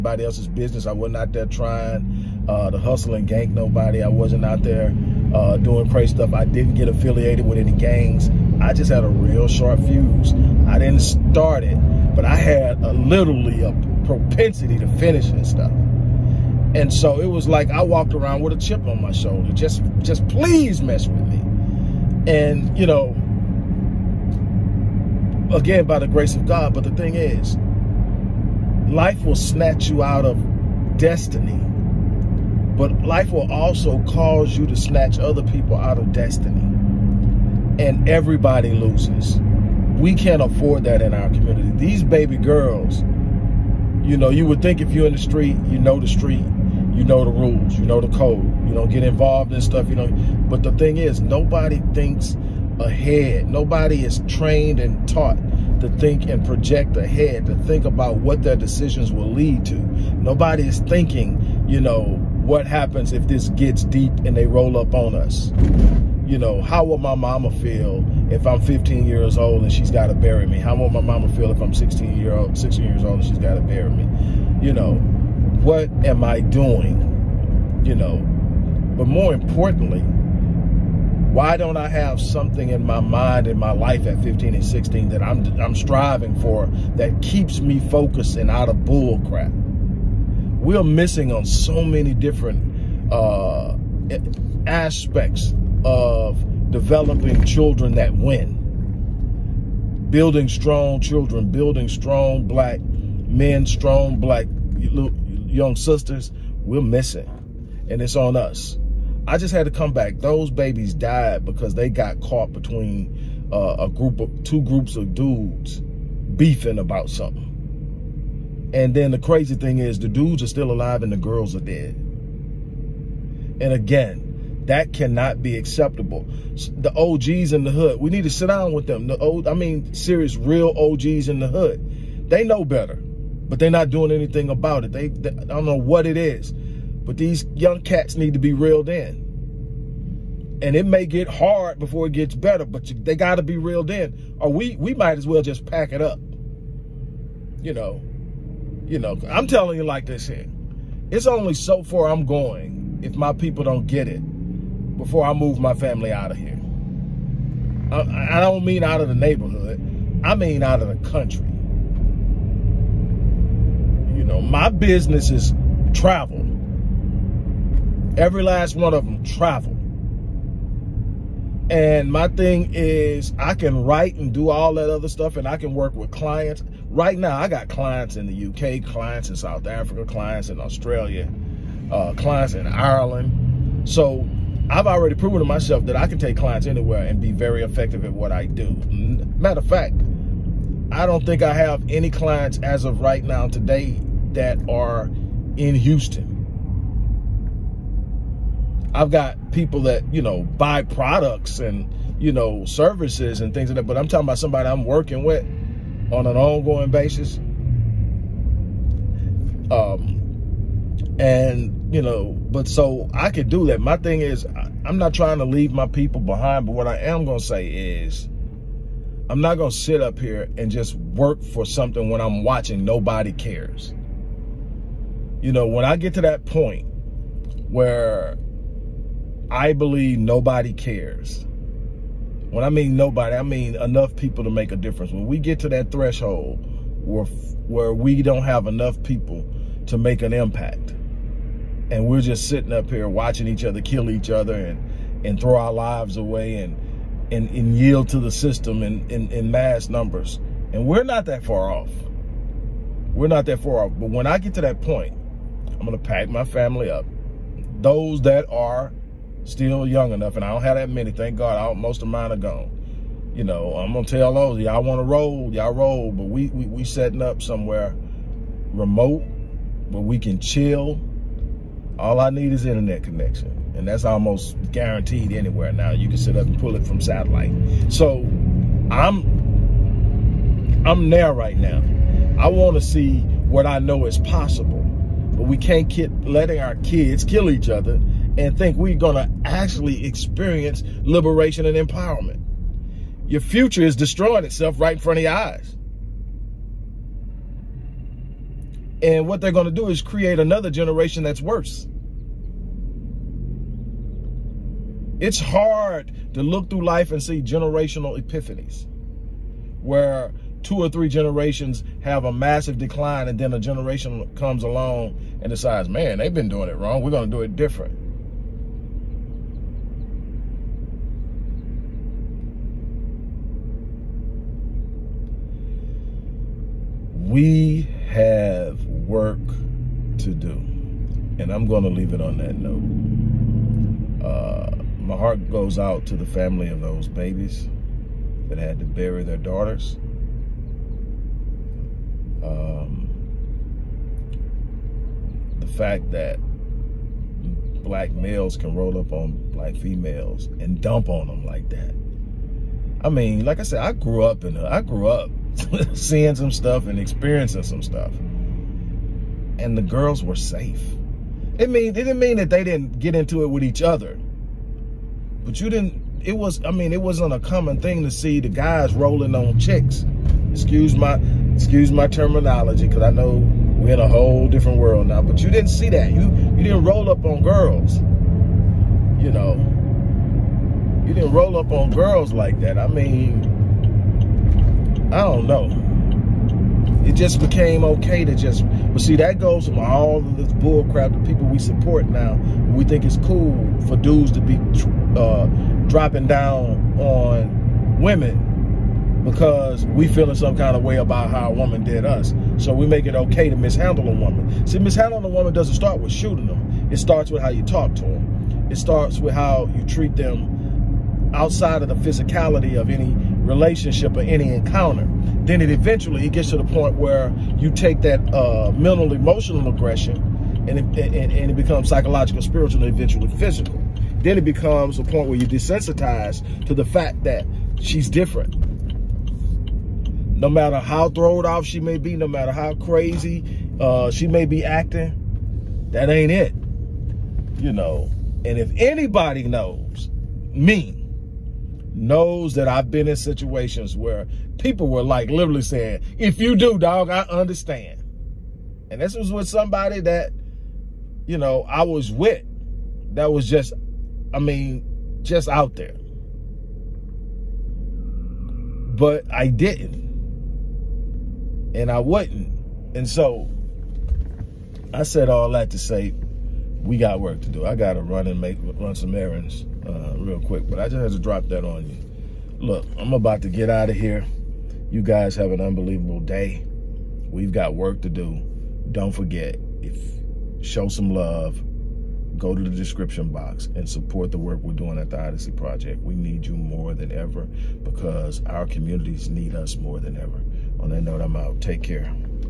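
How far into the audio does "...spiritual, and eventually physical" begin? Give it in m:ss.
7:02.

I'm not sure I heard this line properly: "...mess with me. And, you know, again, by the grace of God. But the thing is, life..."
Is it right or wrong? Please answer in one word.
right.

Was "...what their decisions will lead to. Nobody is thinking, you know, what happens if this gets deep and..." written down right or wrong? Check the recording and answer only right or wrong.
right.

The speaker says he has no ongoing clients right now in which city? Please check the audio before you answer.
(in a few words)
Houston.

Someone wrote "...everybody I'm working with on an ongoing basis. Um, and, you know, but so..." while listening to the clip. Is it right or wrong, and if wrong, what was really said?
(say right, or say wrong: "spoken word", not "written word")
wrong: "somebody", not "everybody".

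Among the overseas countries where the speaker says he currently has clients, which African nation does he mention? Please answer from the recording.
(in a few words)
South Africa.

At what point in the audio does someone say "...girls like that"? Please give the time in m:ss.
6:21.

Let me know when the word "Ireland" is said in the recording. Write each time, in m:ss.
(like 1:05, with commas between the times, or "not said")
3:02.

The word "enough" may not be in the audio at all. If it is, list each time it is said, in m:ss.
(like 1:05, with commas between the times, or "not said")
3:53, 3:58, 4:20.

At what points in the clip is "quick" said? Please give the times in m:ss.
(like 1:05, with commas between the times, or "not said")
7:50.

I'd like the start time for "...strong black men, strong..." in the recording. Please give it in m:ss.
1:41.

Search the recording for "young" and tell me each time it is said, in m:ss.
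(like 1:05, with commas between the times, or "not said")
1:44, 2:17, 4:19.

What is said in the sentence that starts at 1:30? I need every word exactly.
We're missing on so many different uh, aspects of developing children that win.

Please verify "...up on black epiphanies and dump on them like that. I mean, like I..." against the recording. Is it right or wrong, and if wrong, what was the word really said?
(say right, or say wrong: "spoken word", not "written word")
wrong: "females", not "epiphanies".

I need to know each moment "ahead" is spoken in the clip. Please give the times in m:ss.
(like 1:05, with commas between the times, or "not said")
0:52, 0:56.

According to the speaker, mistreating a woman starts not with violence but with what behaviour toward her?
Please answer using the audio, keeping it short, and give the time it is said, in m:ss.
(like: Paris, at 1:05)
Talk to them, at 6:47.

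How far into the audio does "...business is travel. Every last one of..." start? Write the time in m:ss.
2:44.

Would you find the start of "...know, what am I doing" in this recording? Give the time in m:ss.
1:14.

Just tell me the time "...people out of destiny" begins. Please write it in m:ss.
0:35.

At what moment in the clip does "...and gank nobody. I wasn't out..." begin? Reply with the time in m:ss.
0:03.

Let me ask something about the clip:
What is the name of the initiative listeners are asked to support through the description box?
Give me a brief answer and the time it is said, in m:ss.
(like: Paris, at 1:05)
The Odyssey Project, at 8:05.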